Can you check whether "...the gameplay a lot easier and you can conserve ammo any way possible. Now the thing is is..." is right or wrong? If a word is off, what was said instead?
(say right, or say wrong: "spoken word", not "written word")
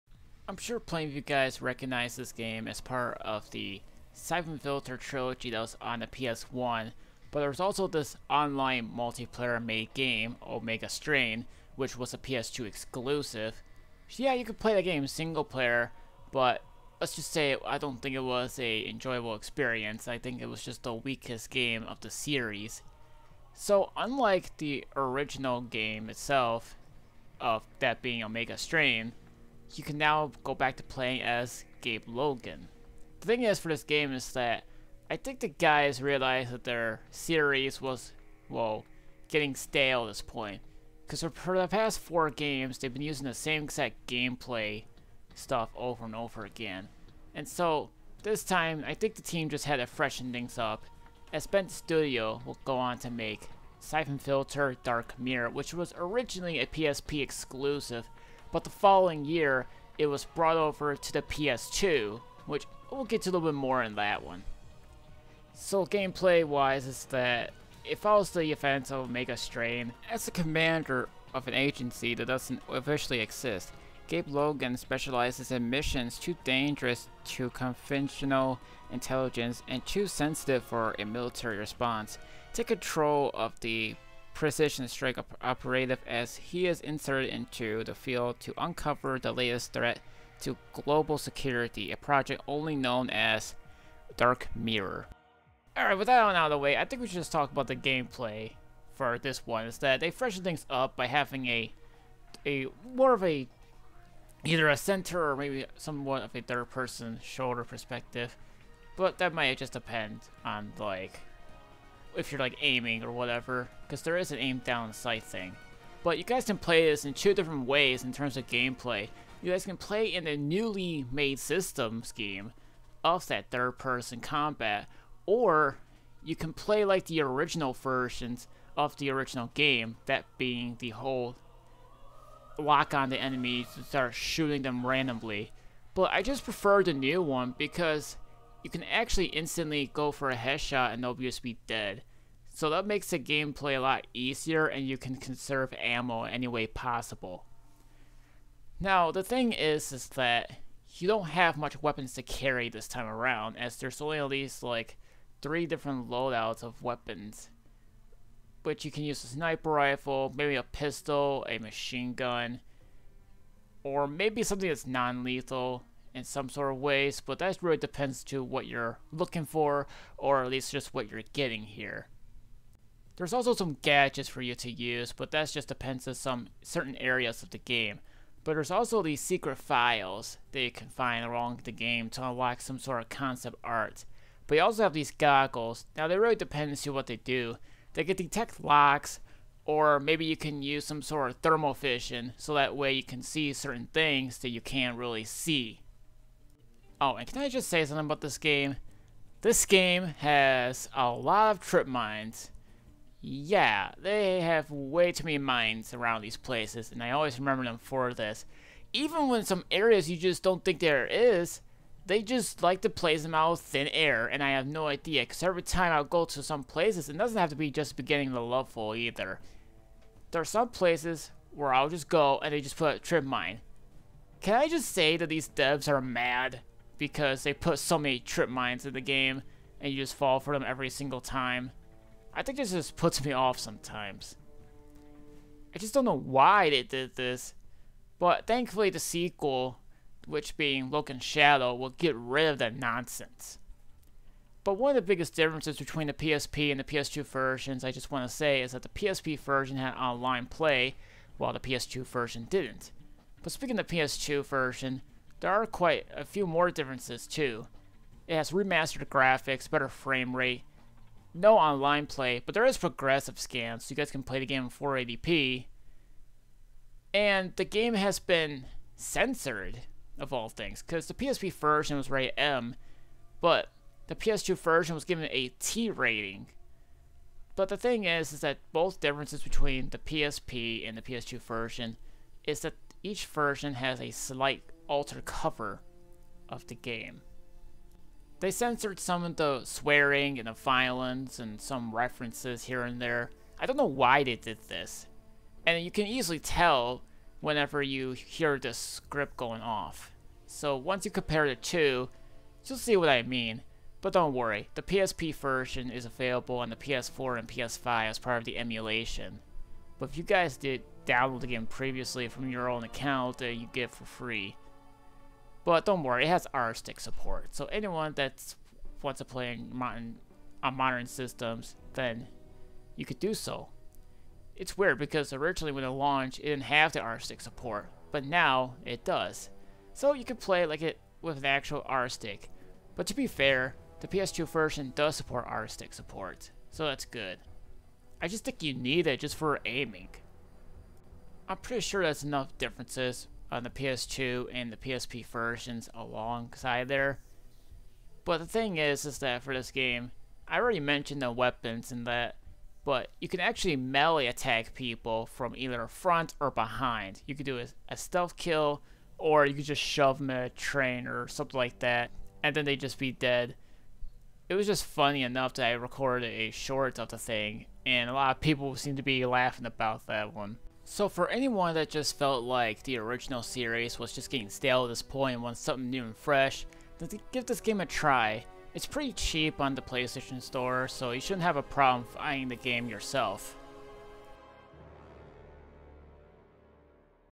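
right.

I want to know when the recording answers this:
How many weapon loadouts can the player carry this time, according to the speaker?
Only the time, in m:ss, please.
2:35.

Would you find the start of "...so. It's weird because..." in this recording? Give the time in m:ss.
5:23.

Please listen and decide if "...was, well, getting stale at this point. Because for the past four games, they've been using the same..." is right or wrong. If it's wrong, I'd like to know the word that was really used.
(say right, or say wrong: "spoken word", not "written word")
right.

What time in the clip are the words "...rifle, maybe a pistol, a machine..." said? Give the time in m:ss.
2:39.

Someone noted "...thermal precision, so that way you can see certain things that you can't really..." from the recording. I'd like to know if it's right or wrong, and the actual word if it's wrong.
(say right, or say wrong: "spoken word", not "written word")
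wrong: "vision", not "precision".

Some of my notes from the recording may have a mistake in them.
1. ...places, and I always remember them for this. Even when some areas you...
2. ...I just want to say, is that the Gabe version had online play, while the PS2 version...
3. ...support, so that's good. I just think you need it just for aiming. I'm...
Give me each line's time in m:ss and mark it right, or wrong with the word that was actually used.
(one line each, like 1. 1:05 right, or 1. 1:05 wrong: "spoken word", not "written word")
1. 3:26 right
2. 4:07 wrong: "PSP", not "Gabe"
3. 5:35 right.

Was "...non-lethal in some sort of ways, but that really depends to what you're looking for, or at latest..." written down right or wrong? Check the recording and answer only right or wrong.
wrong.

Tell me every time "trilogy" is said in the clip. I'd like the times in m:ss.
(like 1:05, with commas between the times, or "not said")
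0:04.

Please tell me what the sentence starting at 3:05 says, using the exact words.
Now, they really depend to what they do.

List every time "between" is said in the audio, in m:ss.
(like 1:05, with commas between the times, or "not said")
4:05, 4:39.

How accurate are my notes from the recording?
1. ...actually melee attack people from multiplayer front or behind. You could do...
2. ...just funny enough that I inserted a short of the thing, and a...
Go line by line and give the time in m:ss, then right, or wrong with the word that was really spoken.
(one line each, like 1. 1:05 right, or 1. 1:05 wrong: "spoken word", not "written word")
1. 5:53 wrong: "either", not "multiplayer"
2. 6:04 wrong: "recorded", not "inserted".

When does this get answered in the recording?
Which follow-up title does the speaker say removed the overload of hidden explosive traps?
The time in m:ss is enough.
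4:00.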